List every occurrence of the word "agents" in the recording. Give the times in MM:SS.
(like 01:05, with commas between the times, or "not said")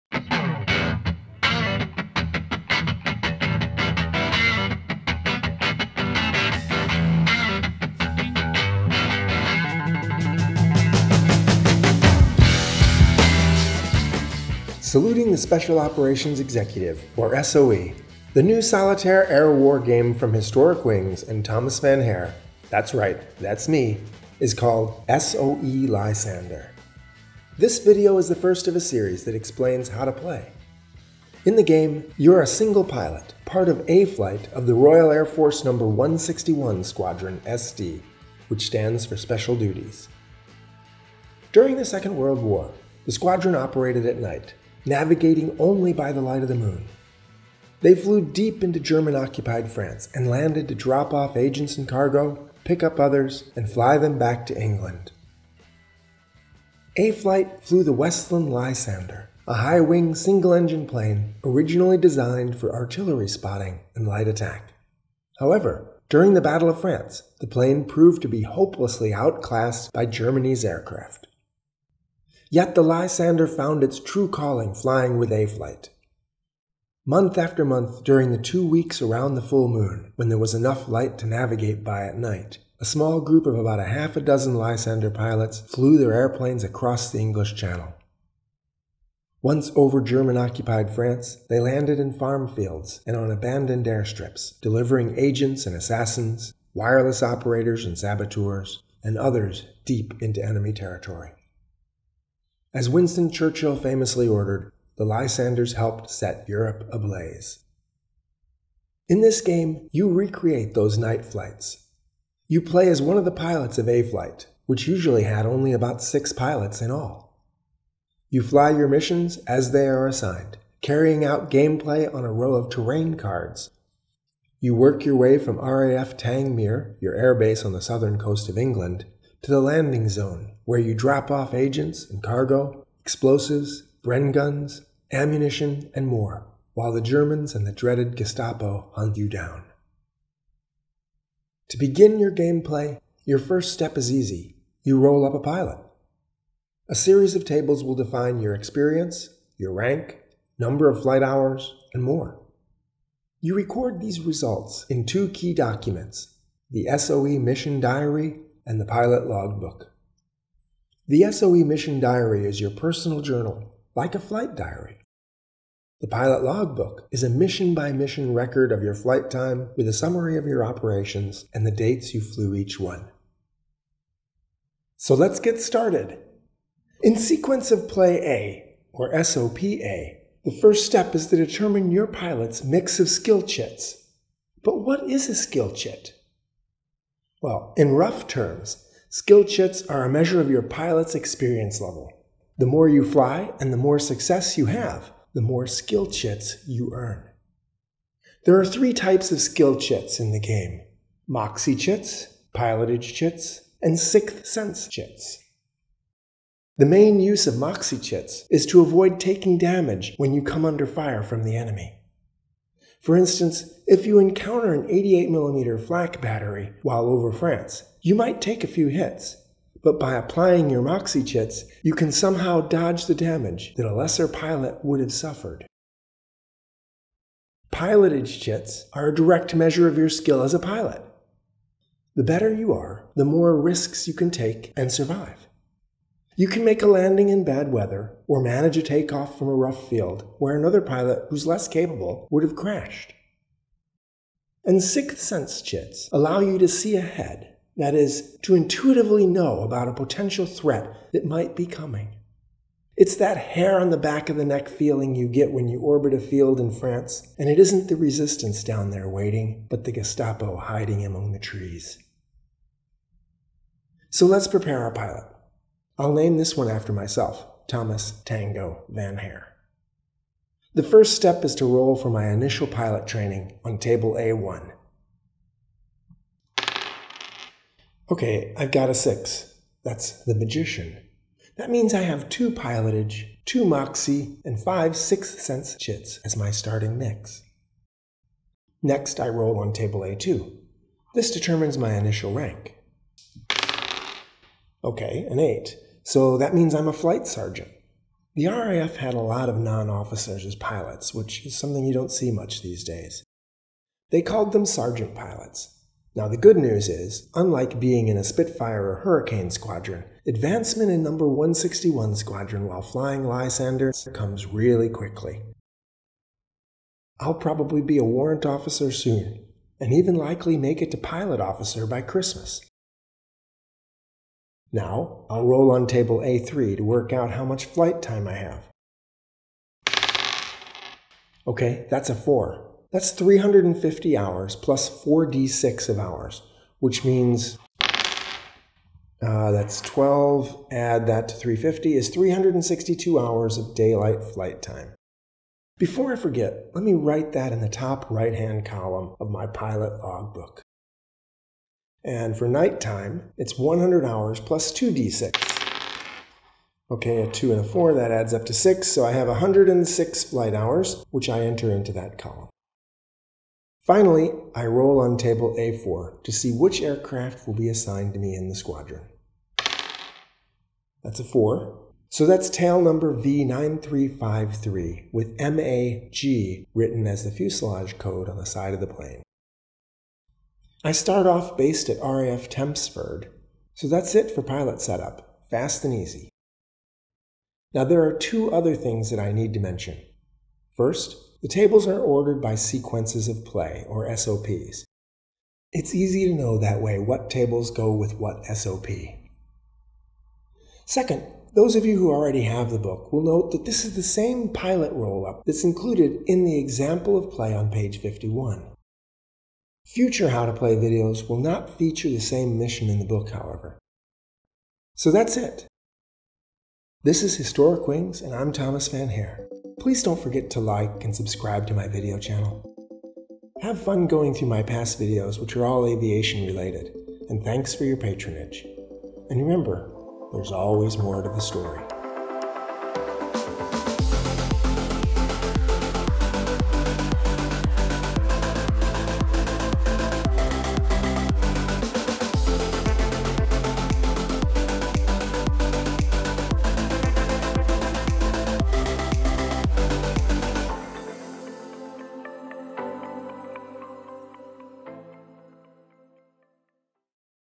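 00:51, 01:35, 02:11.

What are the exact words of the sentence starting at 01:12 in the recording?
Yet the Lysander found its true calling flying with A-Flight.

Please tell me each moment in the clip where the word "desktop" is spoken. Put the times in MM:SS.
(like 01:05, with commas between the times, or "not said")
not said.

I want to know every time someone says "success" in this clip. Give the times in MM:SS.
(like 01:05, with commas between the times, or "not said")
03:13.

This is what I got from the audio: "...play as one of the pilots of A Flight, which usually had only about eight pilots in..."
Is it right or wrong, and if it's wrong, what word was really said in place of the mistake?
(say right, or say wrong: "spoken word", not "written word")
wrong: "six", not "eight".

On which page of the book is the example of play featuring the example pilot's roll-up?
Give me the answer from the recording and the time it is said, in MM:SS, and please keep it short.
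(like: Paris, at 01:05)
51, at 06:47.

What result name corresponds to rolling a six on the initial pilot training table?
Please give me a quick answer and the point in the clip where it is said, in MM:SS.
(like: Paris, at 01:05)
The magician, at 04:40.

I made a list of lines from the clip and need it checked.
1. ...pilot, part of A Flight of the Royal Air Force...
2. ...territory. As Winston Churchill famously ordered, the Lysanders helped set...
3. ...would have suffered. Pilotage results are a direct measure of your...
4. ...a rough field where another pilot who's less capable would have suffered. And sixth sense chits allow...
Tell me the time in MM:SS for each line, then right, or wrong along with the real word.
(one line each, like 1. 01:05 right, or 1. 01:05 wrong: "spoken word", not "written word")
1. 00:32 right
2. 01:40 right
3. 03:44 wrong: "chits", not "results"
4. 03:59 wrong: "crashed", not "suffered".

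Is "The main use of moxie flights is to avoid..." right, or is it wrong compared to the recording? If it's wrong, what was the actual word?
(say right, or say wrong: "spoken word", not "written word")
wrong: "chits", not "flights".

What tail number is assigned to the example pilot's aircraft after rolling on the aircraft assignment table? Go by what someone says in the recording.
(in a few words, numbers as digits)
V9353.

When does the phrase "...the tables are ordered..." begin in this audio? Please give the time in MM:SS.
06:31.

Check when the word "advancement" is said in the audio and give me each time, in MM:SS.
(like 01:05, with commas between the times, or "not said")
05:10.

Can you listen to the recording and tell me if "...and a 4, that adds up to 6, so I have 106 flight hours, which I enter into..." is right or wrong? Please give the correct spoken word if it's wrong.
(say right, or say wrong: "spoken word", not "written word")
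right.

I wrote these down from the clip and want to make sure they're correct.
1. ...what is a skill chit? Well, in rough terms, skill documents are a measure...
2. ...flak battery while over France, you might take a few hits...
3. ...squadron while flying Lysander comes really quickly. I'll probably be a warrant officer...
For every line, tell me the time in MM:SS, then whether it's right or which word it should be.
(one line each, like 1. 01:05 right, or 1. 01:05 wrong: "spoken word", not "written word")
1. 03:04 wrong: "chits", not "documents"
2. 03:35 right
3. 05:12 right.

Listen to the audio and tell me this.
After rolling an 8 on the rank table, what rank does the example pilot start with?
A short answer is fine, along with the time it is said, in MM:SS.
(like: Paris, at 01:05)
Flight sergeant, at 04:56.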